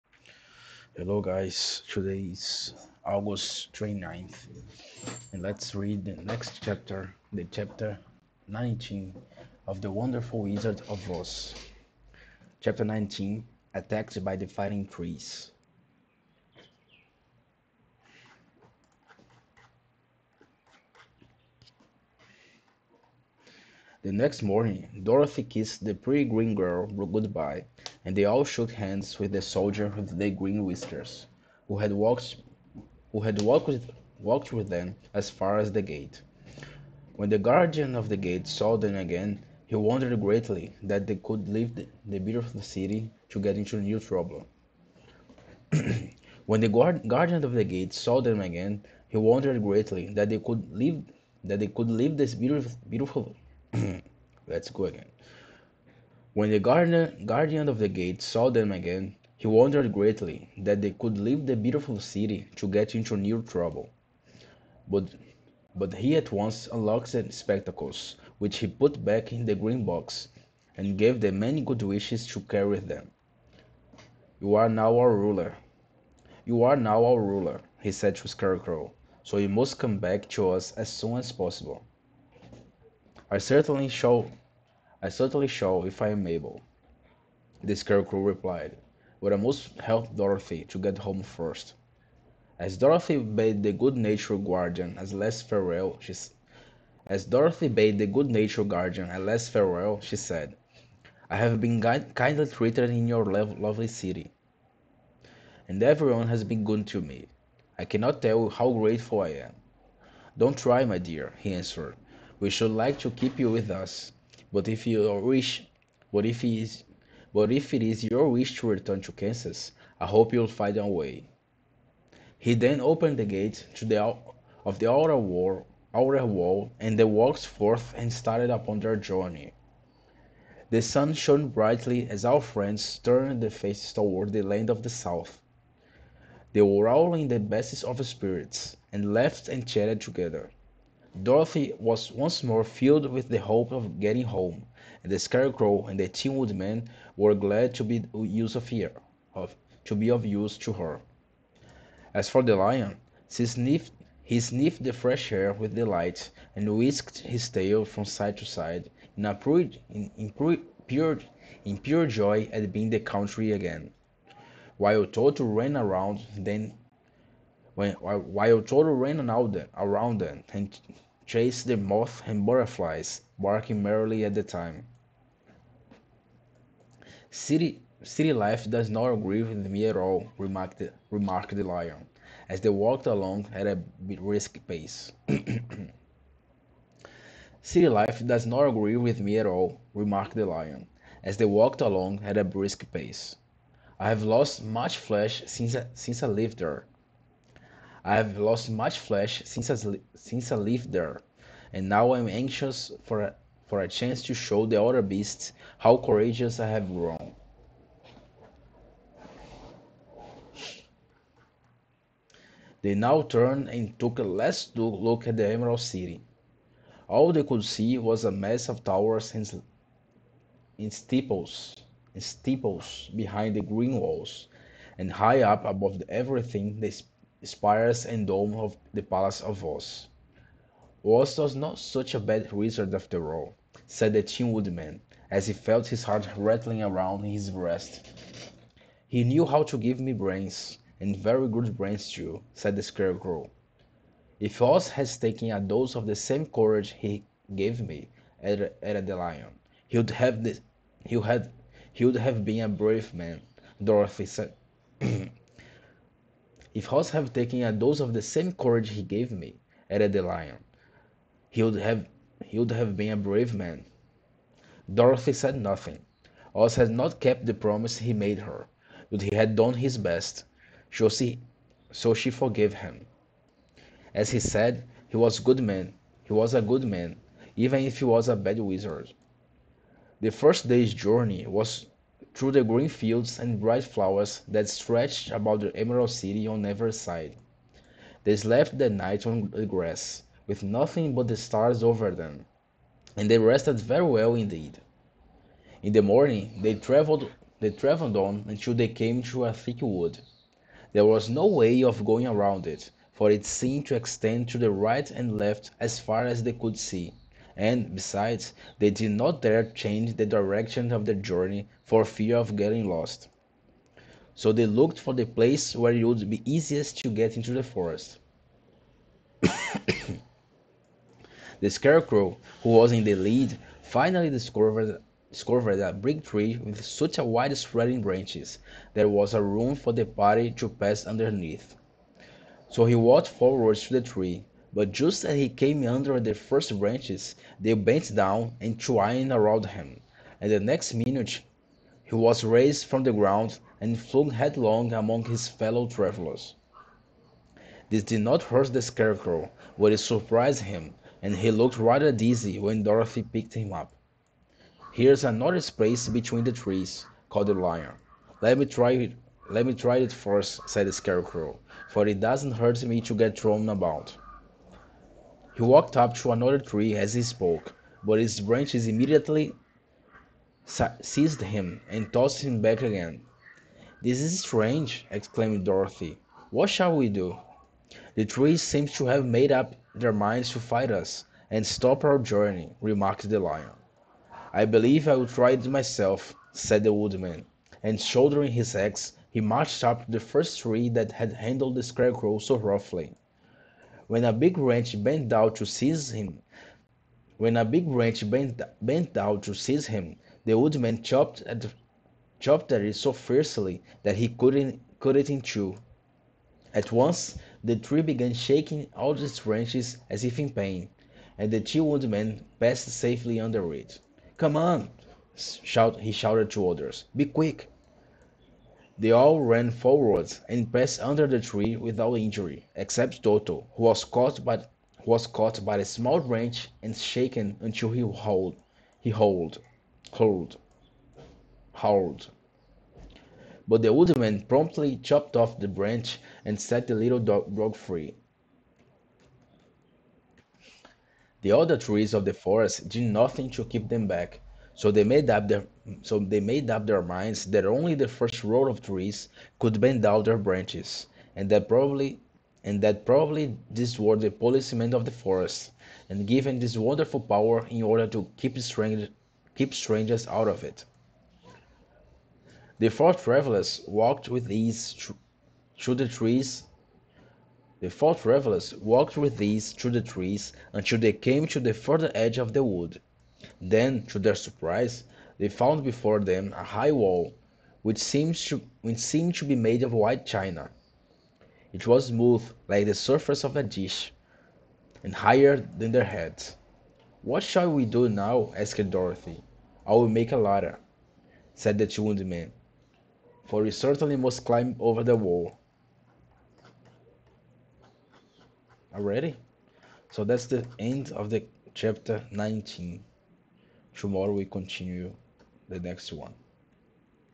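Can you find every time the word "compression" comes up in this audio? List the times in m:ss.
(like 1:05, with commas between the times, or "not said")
not said.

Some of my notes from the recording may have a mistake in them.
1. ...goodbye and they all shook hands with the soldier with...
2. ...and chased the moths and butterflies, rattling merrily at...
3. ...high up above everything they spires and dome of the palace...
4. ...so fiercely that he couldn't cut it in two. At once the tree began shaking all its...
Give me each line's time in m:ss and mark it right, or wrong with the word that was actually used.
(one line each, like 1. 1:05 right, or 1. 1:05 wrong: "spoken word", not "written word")
1. 0:26 right
2. 2:50 wrong: "barking", not "rattling"
3. 3:45 right
4. 6:42 right.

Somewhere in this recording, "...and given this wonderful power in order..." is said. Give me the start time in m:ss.
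7:36.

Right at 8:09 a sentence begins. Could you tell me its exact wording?
"I will make a ladder," said the Tin Woodman, "for we certainly must climb over the wall." Already?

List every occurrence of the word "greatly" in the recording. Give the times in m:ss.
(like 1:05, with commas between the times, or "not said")
0:40, 0:49, 0:59.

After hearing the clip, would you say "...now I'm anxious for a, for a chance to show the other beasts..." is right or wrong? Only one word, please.
right.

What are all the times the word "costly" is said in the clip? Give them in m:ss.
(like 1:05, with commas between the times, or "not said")
not said.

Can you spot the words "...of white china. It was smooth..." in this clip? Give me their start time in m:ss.
7:59.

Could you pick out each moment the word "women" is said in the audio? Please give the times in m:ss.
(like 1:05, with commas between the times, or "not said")
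not said.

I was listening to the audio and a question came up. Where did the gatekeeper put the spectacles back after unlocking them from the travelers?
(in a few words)
the green box.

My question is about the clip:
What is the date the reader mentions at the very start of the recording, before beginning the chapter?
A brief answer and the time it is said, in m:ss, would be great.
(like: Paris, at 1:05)
August 29th, at 0:03.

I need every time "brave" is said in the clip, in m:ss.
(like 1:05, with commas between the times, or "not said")
4:12, 4:23.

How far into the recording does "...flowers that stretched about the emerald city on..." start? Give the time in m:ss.
4:43.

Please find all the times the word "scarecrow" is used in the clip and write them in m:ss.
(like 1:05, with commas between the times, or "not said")
1:18, 1:27, 2:25, 4:02, 5:21, 5:48, 6:00, 6:31.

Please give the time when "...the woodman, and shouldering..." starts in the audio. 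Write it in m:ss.
6:26.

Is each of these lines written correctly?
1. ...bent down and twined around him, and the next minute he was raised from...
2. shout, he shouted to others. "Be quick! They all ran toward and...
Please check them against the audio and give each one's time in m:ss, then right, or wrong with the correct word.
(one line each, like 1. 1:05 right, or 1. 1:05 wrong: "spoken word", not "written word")
1. 5:37 right
2. 6:55 wrong: "forward", not "toward".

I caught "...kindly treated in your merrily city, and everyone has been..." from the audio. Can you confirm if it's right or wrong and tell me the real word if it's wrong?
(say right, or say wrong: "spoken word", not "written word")
wrong: "lovely", not "merrily".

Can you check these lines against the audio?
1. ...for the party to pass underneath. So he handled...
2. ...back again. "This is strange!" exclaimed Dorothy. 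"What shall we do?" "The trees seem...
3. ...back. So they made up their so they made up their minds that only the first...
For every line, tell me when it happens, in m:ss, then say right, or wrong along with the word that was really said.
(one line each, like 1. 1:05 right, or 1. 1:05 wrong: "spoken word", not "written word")
1. 5:29 wrong: "walked", not "handled"
2. 6:12 right
3. 7:24 right.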